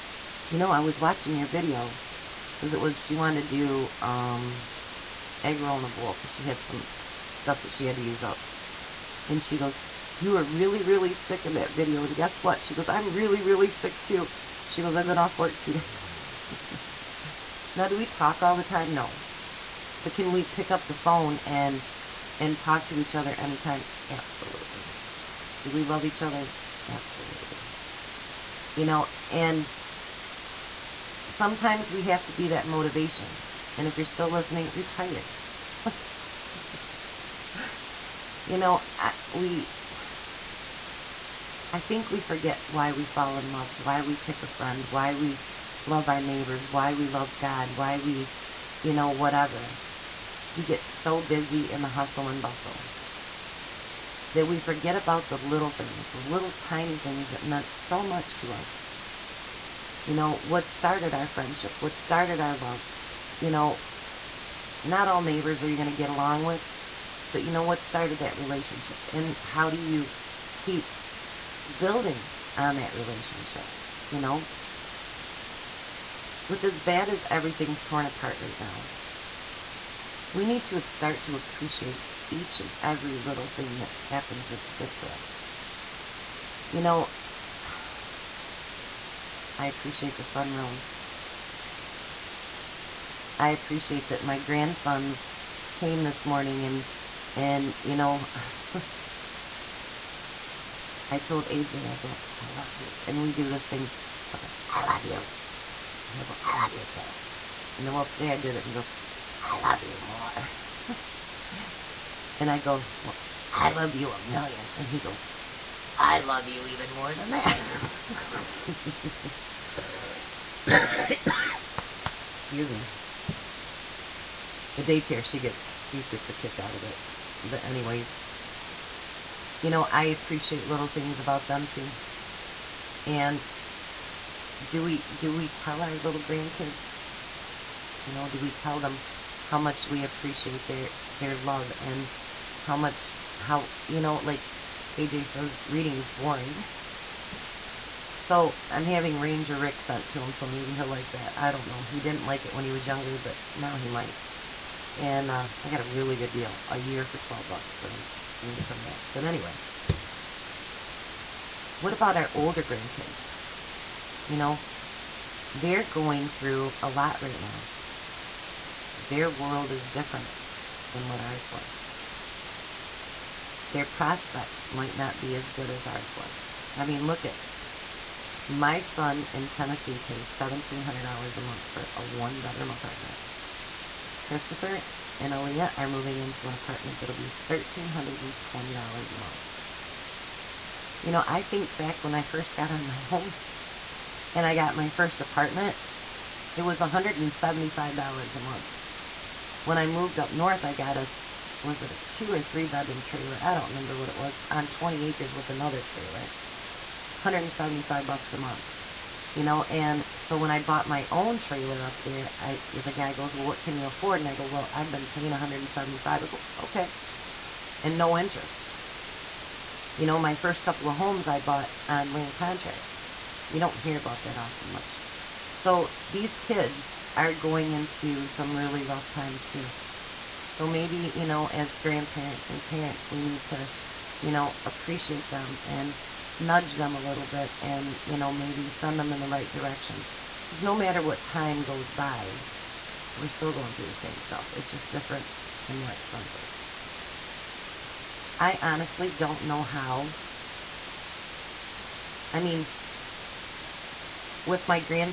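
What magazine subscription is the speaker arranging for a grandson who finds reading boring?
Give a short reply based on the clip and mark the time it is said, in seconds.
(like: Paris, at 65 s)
Ranger Rick, at 149 s.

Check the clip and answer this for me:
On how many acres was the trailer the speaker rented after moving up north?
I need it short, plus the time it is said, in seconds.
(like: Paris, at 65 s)
20, at 204 s.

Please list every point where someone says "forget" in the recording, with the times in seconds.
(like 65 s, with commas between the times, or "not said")
42 s, 54 s.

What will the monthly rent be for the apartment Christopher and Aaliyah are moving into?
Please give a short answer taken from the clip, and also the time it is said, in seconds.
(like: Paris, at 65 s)
$1,320, at 187 s.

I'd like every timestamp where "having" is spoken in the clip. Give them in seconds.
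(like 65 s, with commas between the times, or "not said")
148 s.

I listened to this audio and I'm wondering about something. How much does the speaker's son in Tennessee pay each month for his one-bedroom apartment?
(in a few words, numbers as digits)
$1,700.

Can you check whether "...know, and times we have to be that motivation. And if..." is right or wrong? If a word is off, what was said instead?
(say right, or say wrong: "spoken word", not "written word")
wrong: "sometimes", not "times".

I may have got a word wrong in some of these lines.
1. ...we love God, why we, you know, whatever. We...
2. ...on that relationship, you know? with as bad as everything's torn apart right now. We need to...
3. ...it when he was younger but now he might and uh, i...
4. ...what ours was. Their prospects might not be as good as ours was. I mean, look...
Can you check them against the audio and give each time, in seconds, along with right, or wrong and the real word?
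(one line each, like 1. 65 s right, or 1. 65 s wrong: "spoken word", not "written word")
1. 46 s right
2. 72 s right
3. 152 s right
4. 171 s right.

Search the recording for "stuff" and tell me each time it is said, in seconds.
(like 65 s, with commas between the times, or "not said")
7 s, 244 s.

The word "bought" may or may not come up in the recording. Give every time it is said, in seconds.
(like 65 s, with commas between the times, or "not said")
210 s, 221 s.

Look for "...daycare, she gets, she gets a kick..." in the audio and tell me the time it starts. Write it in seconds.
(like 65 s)
124 s.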